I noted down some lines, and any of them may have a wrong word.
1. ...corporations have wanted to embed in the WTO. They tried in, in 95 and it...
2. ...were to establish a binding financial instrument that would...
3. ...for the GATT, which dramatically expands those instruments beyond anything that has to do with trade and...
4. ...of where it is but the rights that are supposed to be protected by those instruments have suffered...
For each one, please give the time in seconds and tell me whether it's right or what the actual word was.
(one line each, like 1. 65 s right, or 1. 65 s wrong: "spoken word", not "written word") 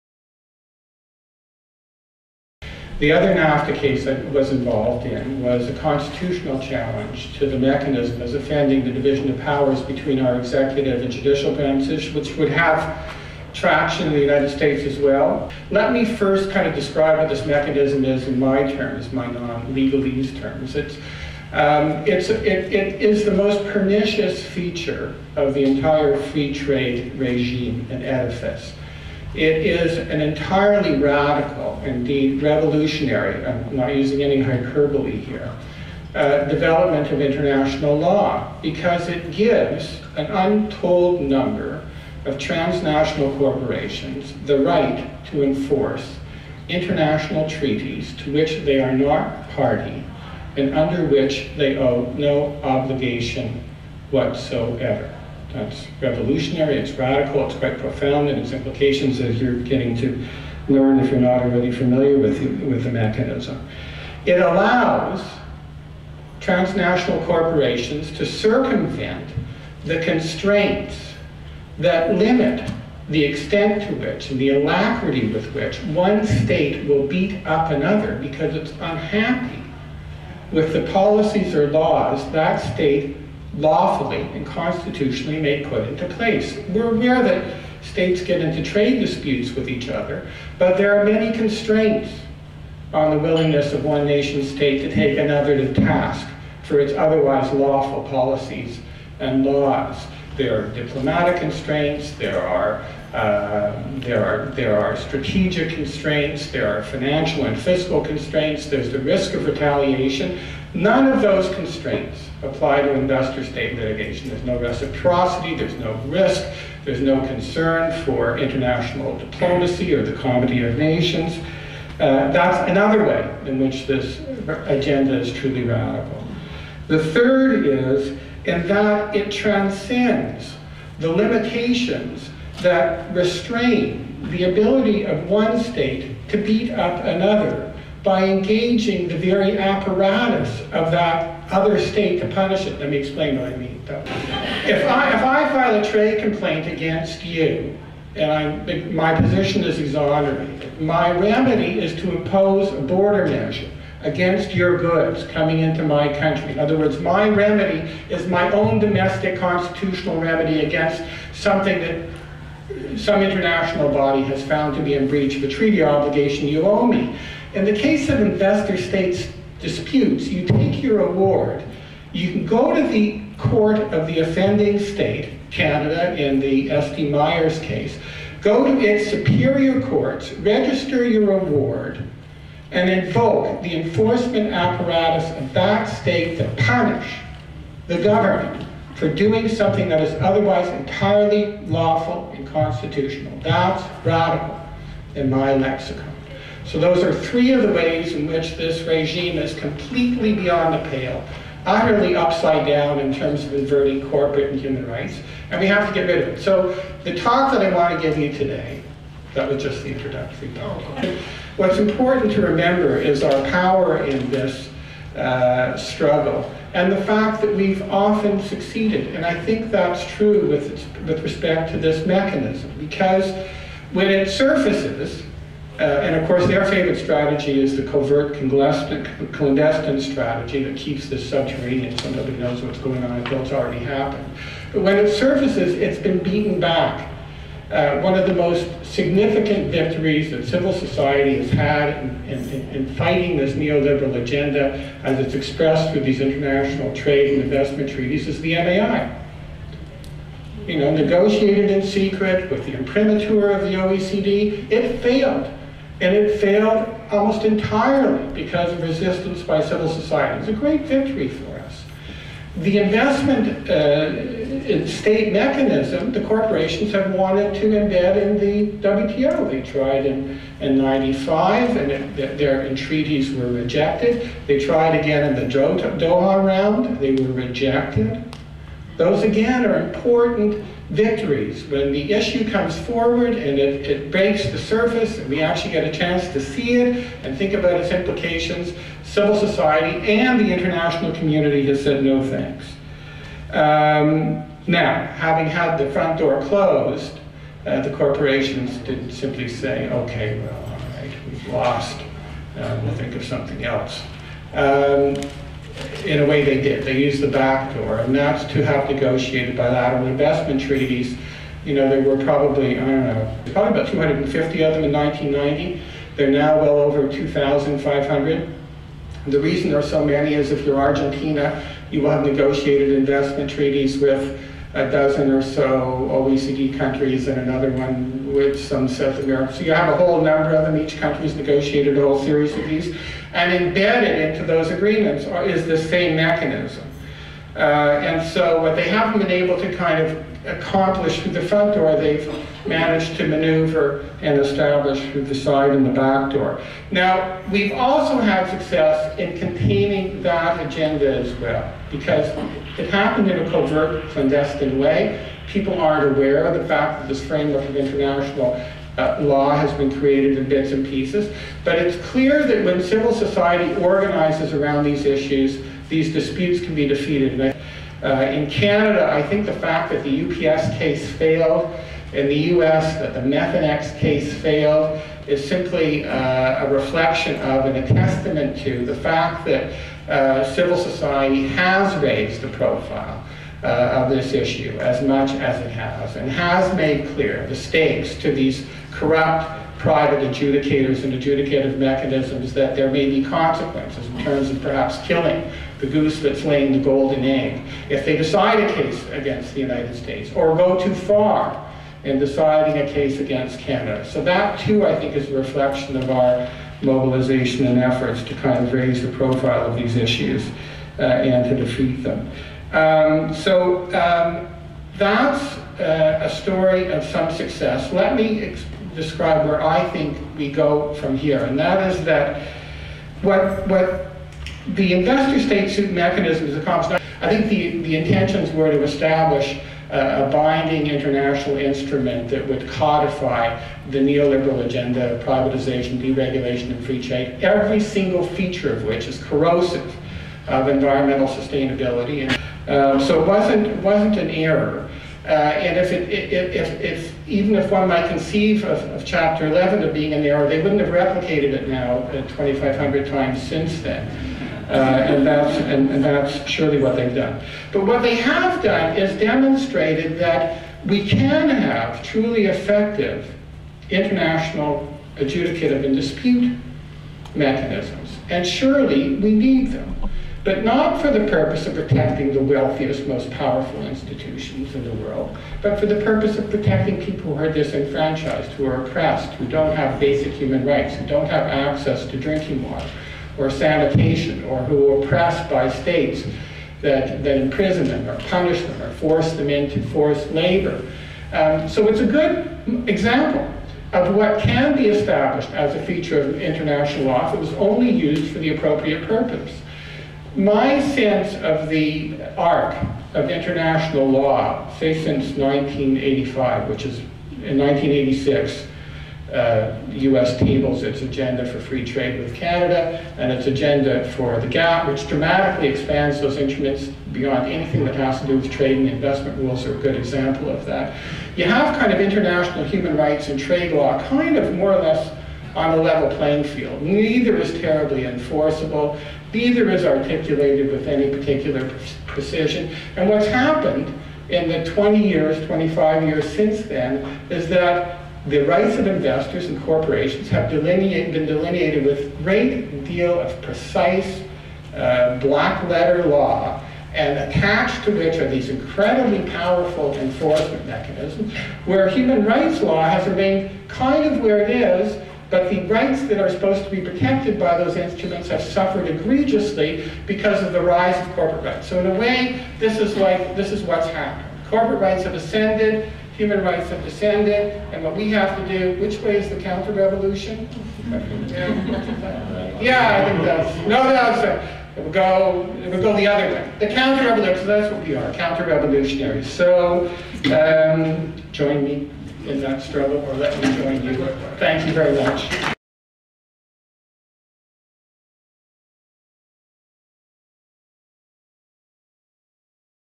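1. 266 s right
2. 428 s wrong: "international", not "financial"
3. 514 s right
4. 554 s right.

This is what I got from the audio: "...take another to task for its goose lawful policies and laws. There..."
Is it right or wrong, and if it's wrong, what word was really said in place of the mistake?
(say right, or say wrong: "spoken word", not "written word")
wrong: "otherwise", not "goose".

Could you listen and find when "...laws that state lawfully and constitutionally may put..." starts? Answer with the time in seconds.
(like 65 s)
81 s.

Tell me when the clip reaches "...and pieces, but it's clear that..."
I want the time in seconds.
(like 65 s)
360 s.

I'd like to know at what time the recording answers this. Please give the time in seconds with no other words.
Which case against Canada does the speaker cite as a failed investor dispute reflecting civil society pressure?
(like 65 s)
370 s.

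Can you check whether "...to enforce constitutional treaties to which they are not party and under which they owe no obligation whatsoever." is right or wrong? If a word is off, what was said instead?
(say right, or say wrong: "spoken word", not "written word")
wrong: "international", not "constitutional".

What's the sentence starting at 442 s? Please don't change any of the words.
And, um, so it wasn't, wasn't an error.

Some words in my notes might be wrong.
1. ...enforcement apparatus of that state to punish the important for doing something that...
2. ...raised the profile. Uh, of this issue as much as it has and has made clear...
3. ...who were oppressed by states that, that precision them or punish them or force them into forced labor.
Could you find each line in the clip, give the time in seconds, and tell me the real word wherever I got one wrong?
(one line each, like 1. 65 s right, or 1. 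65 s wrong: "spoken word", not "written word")
1. 183 s wrong: "government", not "important"
2. 382 s right
3. 484 s wrong: "imprison", not "precision".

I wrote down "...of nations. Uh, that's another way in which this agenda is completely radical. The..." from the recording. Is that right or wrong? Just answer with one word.
wrong.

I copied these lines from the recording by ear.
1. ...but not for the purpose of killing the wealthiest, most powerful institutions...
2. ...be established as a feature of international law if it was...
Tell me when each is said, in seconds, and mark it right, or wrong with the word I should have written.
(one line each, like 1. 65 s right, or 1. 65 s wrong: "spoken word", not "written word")
1. 470 s wrong: "protecting", not "killing"
2. 494 s right.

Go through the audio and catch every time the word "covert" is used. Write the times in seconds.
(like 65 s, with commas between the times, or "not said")
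227 s, 353 s.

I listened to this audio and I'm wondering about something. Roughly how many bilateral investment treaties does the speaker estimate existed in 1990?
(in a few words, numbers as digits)
250.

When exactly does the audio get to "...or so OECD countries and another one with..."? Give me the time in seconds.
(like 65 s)
325 s.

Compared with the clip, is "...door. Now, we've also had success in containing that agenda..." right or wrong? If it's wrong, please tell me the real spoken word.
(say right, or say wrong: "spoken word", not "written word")
right.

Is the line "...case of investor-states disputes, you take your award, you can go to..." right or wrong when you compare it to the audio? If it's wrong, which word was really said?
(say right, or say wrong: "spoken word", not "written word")
right.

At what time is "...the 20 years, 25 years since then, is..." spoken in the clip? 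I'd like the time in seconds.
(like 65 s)
534 s.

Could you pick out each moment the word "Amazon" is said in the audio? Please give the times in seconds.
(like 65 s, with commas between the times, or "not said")
not said.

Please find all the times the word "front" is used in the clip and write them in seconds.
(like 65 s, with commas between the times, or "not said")
295 s, 341 s.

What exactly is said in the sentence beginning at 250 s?
You know, negotiated in secret with the imprimatur of the OECD, it failed.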